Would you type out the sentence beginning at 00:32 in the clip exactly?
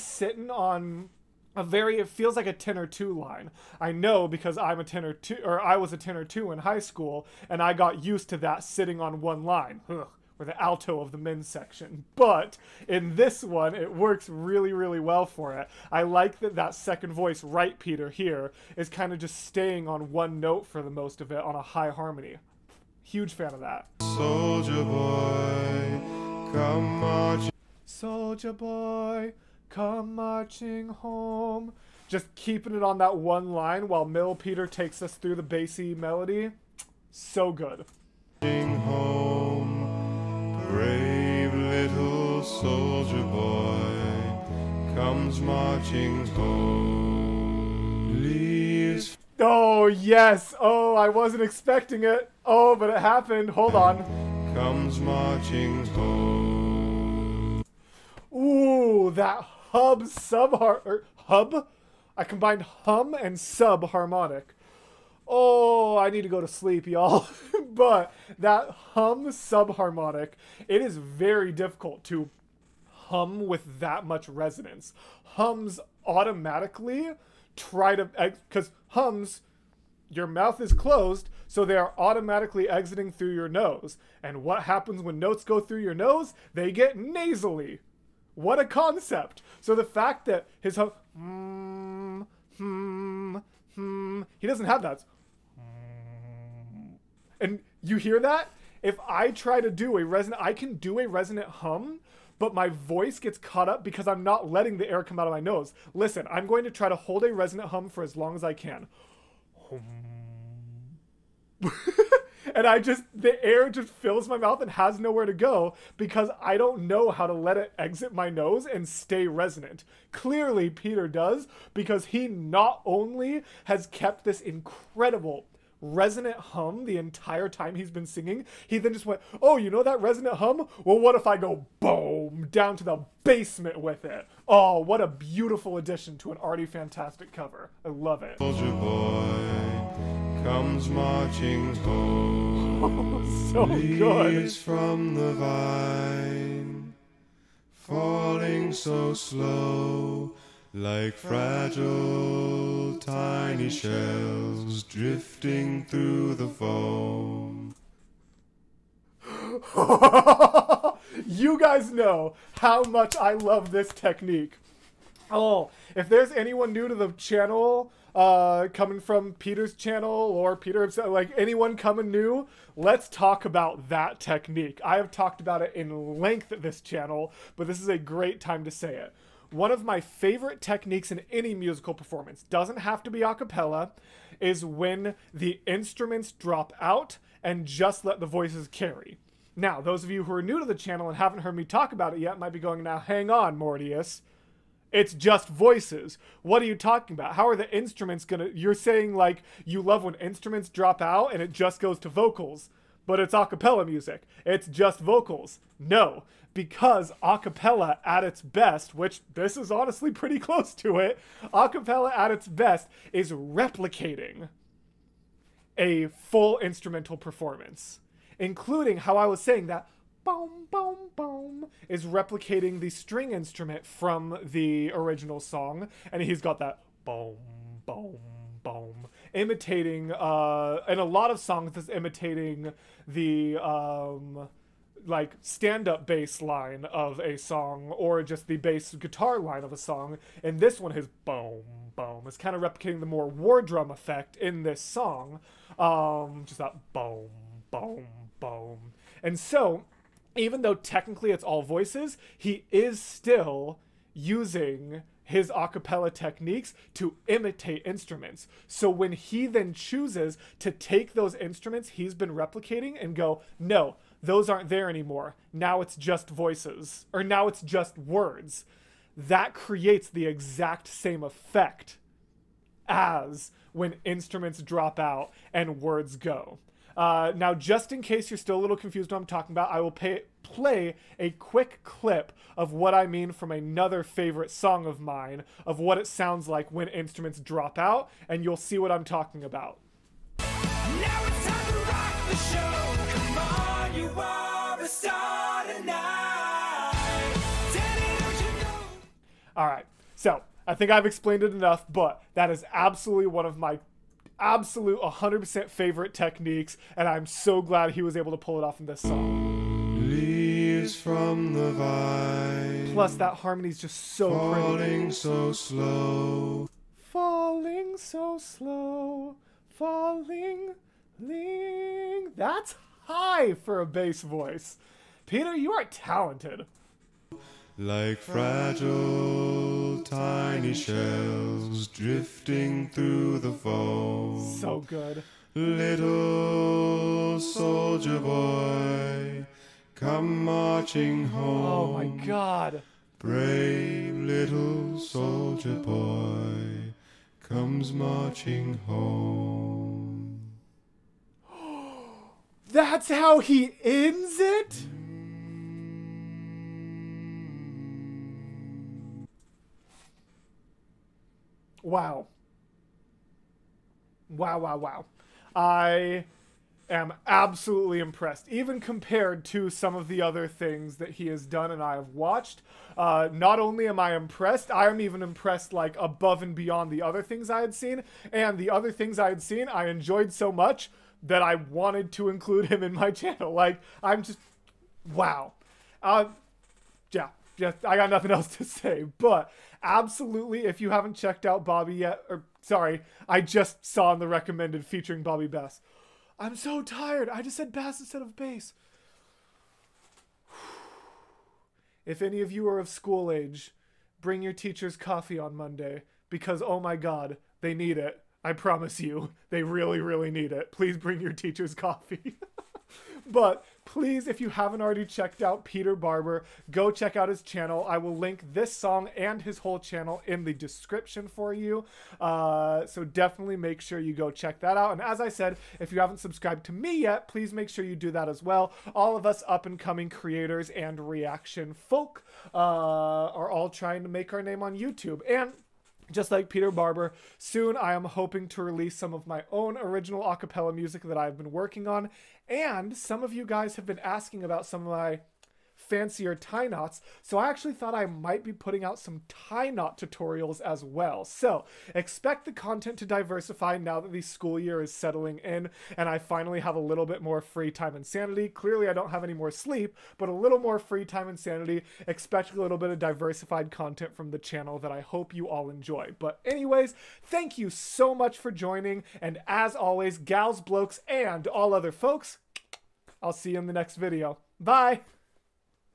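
Just keeping it on that one line while Mill Peter takes us through the bassy melody.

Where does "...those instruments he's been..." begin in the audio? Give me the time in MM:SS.
04:21.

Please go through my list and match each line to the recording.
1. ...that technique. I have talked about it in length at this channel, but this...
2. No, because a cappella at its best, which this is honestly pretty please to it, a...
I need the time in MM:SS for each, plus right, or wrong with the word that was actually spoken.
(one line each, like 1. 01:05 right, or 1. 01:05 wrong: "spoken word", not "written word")
1. 02:53 right
2. 03:25 wrong: "close", not "please".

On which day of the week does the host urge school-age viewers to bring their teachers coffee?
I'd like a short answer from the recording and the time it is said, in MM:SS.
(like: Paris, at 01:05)
Monday, at 06:45.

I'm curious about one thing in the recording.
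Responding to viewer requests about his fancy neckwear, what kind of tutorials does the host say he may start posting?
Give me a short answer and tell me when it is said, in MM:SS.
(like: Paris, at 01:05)
tie knot tutorials, at 07:29.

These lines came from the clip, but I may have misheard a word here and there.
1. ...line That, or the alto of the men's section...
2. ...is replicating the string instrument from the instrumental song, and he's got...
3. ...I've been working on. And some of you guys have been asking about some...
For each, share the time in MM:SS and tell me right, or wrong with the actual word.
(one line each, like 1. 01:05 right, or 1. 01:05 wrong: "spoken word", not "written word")
1. 00:09 wrong: "Ugh", not "That"
2. 03:41 wrong: "original", not "instrumental"
3. 07:21 right.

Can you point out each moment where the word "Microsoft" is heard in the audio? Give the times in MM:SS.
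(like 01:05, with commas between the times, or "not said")
not said.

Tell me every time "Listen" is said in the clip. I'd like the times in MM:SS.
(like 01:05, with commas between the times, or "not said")
01:45.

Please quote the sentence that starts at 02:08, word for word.
He then just went, "Oh, you know that resonant hum?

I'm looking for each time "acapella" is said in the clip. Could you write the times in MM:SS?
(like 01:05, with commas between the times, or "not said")
04:15, 07:20.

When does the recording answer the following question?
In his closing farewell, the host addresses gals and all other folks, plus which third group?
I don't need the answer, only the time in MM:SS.
07:50.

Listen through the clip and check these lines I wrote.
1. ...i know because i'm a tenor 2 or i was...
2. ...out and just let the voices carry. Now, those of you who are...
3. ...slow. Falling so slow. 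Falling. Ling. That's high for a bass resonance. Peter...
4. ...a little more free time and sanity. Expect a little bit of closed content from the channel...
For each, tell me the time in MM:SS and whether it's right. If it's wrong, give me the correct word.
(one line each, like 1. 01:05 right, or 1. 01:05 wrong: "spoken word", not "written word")
1. 00:03 right
2. 03:06 right
3. 05:15 wrong: "voice", not "resonance"
4. 07:40 wrong: "diversified", not "closed".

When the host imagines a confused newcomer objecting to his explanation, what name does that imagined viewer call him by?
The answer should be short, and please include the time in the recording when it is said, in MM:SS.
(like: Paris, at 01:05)
Mortius, at 03:13.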